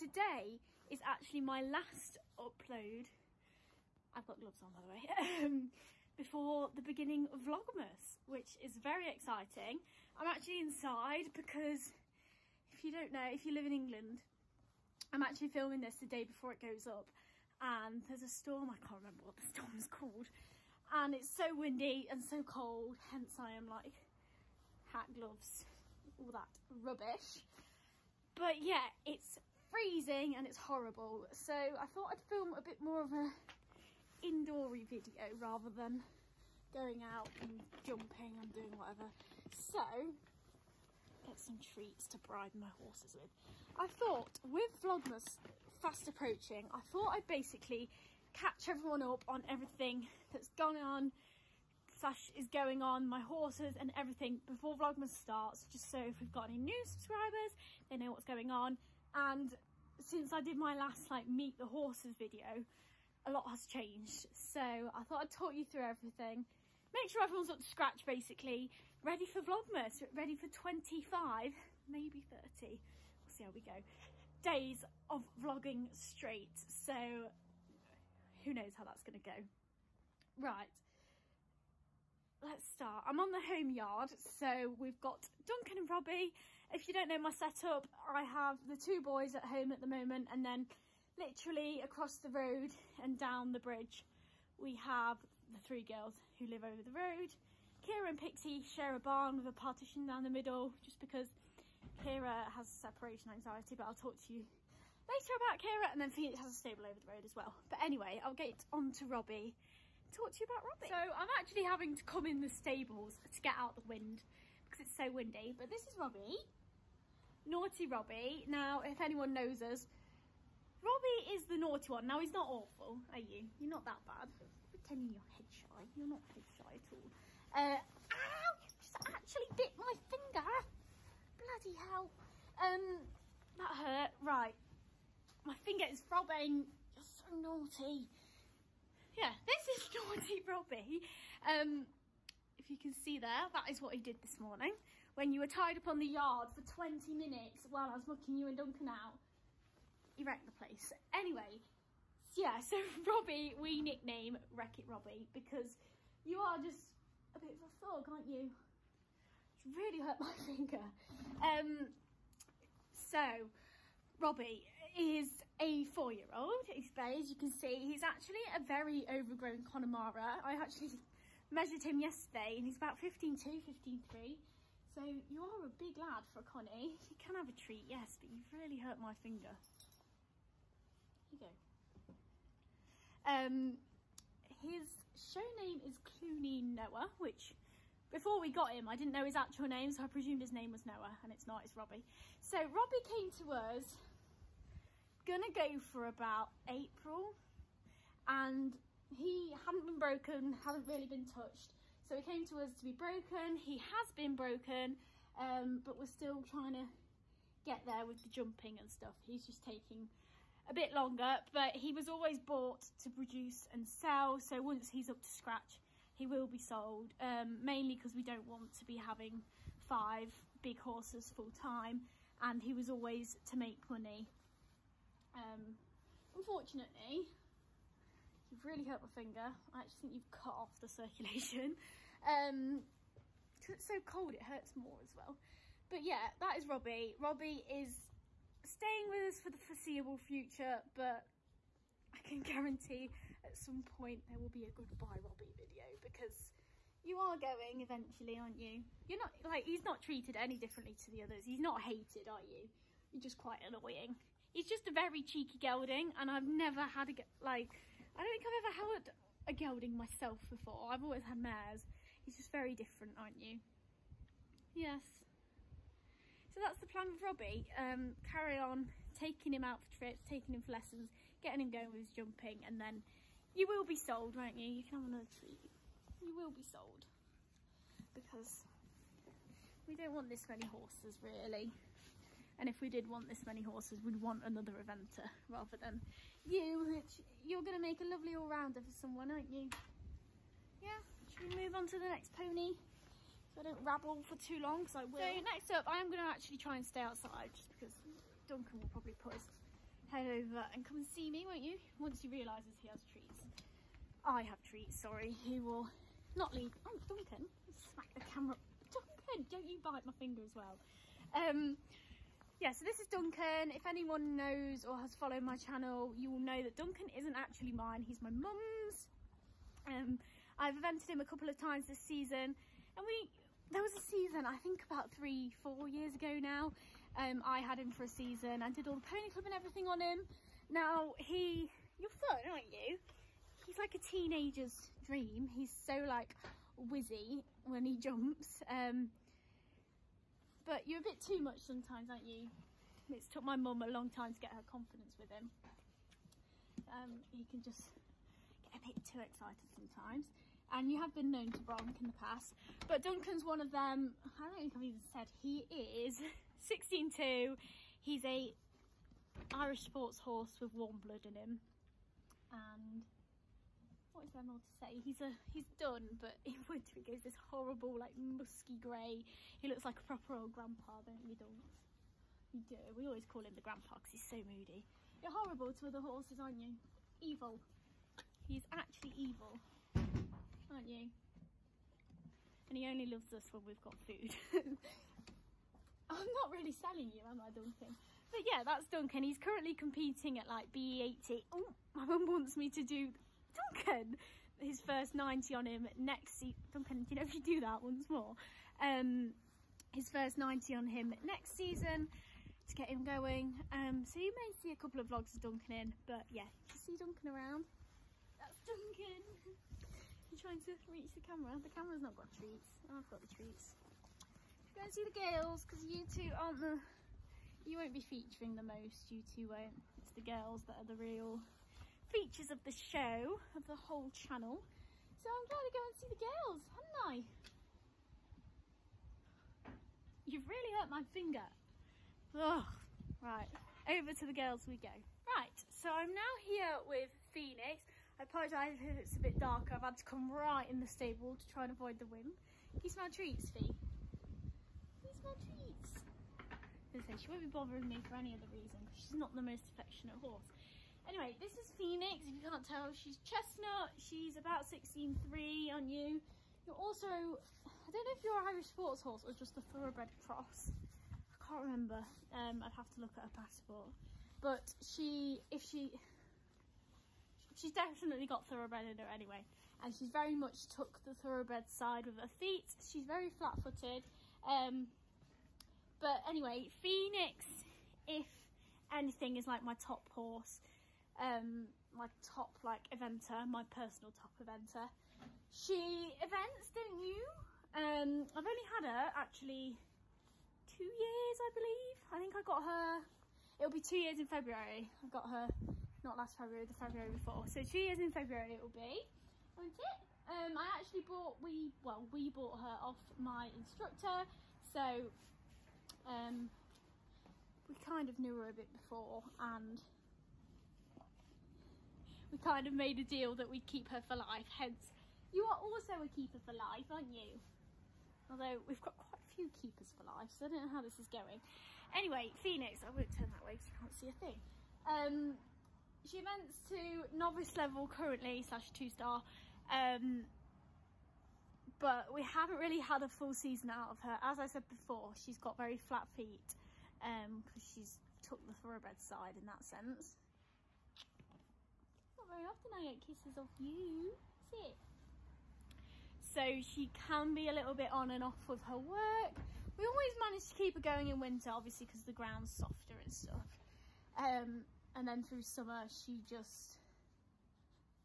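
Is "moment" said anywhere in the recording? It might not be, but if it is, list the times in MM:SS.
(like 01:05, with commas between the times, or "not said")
01:29.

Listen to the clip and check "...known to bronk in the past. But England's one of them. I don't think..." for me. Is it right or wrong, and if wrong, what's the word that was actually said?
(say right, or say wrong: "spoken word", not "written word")
wrong: "Duncan", not "England".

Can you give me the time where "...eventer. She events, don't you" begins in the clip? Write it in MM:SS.
08:04.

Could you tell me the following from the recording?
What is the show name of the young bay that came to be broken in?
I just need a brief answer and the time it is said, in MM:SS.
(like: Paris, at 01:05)
Clooney Noah, at 03:05.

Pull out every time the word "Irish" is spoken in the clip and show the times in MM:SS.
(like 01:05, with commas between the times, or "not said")
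05:59, 07:38.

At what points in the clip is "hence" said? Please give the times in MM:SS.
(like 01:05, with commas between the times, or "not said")
00:22, 08:34.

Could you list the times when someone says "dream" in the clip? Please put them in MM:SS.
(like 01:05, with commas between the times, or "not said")
05:35.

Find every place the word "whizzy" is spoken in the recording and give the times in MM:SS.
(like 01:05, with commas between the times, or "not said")
05:36.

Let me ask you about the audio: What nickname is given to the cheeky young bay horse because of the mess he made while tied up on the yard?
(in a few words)
Wreck-It Robbie.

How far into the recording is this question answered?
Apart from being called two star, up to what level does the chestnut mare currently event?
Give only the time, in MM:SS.
08:47.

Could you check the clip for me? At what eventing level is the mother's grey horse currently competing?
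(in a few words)
BE80.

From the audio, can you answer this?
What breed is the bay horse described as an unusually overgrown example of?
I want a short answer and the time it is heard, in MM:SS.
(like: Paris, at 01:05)
Connemara, at 02:49.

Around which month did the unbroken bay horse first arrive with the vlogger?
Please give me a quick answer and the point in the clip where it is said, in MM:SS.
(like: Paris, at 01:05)
April, at 03:16.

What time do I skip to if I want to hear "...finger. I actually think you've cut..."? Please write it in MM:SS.
03:49.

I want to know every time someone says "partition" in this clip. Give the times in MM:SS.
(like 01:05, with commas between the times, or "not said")
01:39.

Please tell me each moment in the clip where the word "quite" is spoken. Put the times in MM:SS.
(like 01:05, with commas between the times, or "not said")
04:13, 08:38.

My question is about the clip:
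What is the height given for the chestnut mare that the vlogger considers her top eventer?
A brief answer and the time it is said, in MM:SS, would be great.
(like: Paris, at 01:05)
16.3, at 07:34.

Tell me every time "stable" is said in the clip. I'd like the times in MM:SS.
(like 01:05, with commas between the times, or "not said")
01:46, 01:52, 07:20.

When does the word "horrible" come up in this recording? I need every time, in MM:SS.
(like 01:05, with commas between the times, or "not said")
00:30, 06:07, 06:15.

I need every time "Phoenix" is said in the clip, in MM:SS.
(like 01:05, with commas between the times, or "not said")
01:46, 07:17, 07:31, 07:56, 08:42.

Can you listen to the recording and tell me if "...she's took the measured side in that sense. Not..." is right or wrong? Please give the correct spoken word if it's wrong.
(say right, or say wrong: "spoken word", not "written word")
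wrong: "thoroughbred", not "measured".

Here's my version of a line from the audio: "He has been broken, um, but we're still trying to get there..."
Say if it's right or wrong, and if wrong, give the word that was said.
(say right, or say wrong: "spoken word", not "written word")
right.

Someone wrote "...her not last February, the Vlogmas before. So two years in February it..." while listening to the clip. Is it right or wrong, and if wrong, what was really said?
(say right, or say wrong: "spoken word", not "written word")
wrong: "February", not "Vlogmas".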